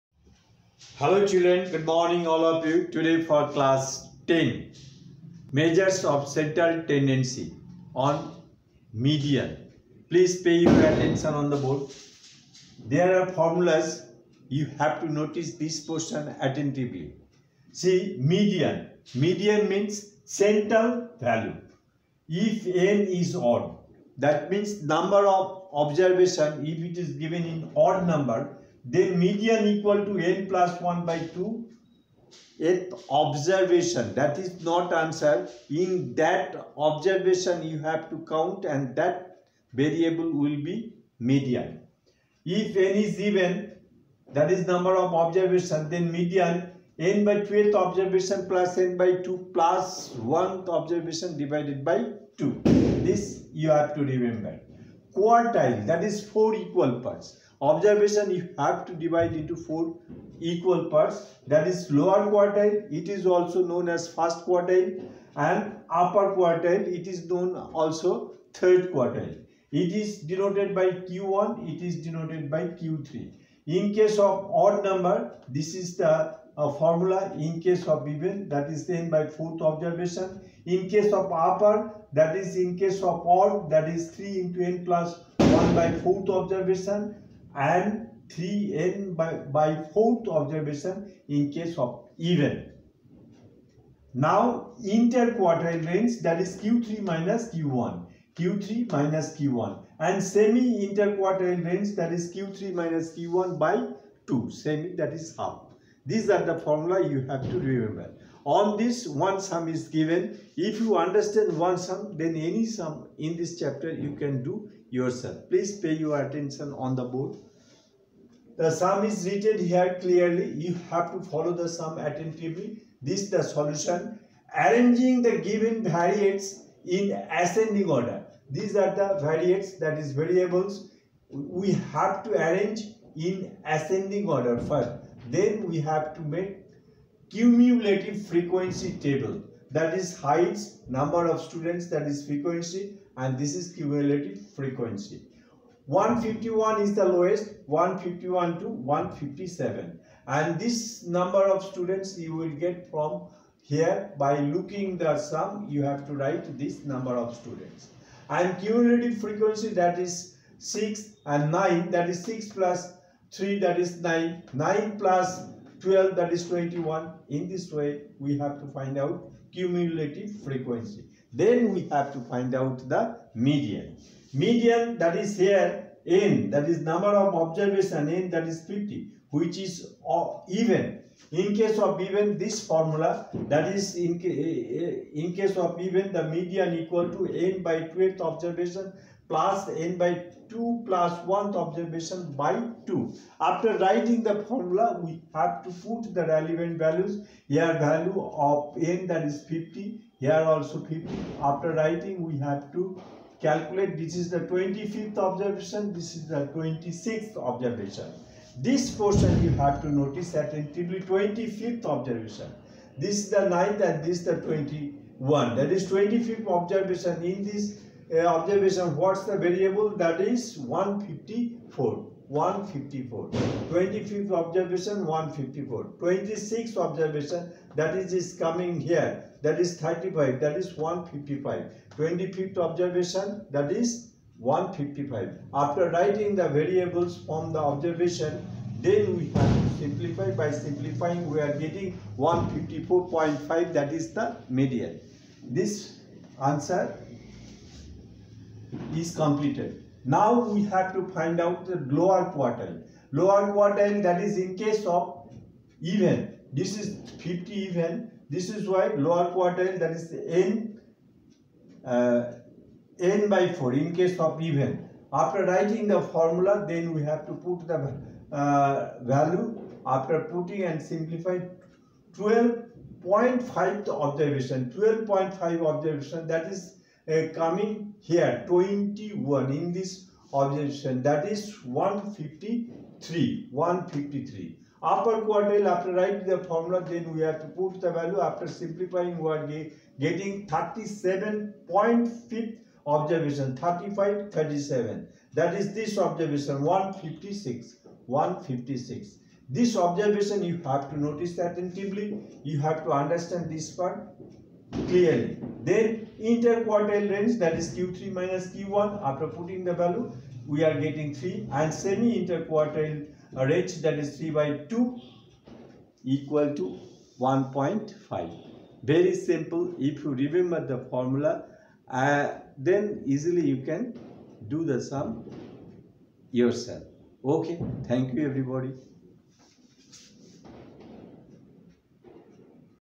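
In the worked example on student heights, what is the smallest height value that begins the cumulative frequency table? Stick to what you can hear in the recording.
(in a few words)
151.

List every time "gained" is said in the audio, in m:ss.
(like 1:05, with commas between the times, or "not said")
not said.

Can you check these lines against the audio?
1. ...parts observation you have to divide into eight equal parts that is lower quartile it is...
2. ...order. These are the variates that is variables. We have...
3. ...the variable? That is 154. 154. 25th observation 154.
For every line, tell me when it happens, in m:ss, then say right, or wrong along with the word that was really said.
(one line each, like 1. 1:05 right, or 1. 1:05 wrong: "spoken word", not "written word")
1. 0:57 wrong: "four", not "eight"
2. 2:07 right
3. 3:39 right.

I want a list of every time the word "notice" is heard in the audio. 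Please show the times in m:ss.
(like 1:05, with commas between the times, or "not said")
0:15, 3:29, 5:00.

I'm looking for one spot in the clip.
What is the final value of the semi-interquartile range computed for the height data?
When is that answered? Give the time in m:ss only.
5:17.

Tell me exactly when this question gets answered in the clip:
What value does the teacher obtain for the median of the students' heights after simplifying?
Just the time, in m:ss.
4:02.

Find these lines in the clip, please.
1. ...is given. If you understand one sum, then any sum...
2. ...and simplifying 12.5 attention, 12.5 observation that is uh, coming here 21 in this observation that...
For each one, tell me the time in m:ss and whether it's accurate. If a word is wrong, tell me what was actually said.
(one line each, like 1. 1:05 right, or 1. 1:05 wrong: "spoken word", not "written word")
1. 1:49 right
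2. 4:30 wrong: "observation", not "attention".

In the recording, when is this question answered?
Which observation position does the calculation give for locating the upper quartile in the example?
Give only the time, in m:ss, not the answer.
4:50.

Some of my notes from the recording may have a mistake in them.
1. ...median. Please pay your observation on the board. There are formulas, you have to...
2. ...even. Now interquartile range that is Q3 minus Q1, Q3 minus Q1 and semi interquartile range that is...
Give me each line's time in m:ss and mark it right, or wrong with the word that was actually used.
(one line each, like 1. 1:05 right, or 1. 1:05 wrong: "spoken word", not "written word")
1. 0:08 wrong: "attention", not "observation"
2. 1:32 right.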